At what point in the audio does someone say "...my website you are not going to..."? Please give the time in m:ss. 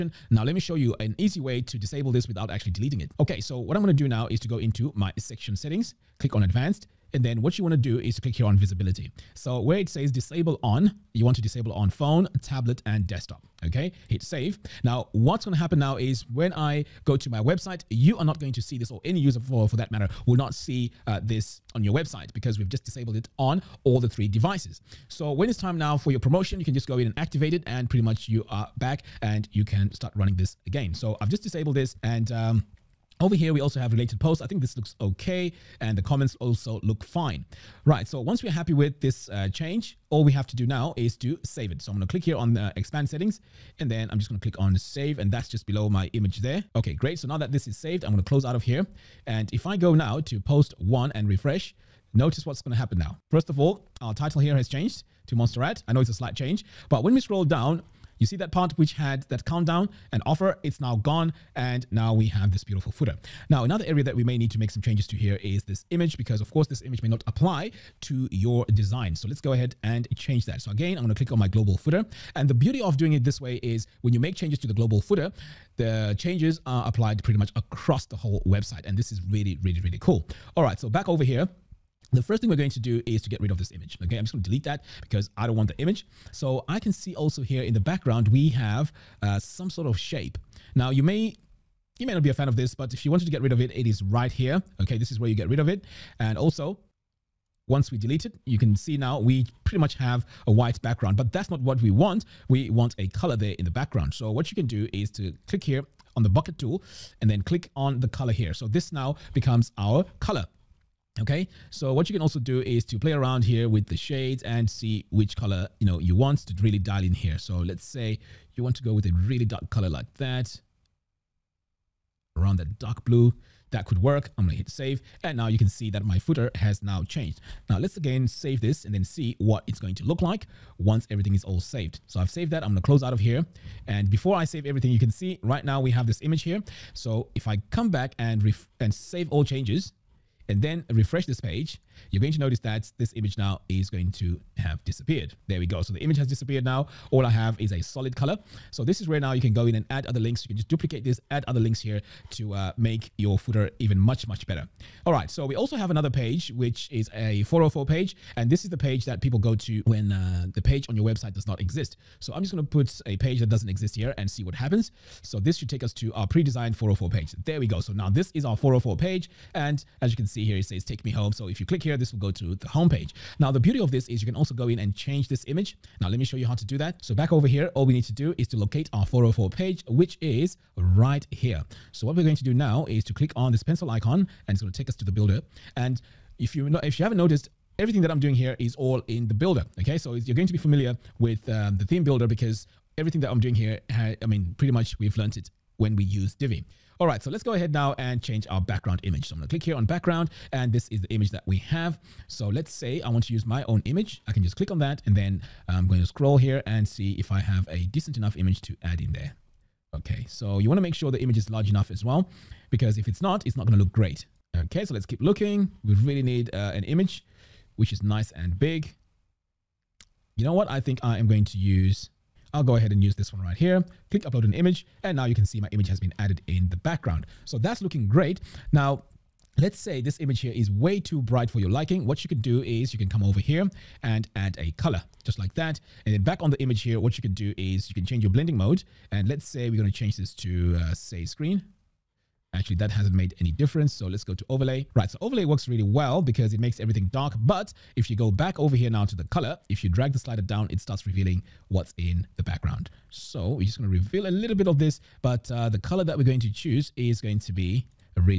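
0:17.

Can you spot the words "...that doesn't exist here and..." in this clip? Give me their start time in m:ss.
2:43.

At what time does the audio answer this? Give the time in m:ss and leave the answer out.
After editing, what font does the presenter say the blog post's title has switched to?
0:55.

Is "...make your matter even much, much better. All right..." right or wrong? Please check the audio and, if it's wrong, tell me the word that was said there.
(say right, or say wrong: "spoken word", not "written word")
wrong: "footer", not "matter".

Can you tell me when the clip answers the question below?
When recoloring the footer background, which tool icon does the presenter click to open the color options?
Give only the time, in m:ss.
1:46.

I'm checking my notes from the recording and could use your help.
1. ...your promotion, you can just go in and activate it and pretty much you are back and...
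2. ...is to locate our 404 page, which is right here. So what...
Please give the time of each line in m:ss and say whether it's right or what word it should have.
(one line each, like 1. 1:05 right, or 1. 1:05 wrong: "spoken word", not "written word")
1. 0:26 right
2. 2:58 right.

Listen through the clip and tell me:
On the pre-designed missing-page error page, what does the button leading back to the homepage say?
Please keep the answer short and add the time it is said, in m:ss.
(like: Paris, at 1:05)
Take me home, at 2:50.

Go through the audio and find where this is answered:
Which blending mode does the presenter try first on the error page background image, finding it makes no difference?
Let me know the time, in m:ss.
4:01.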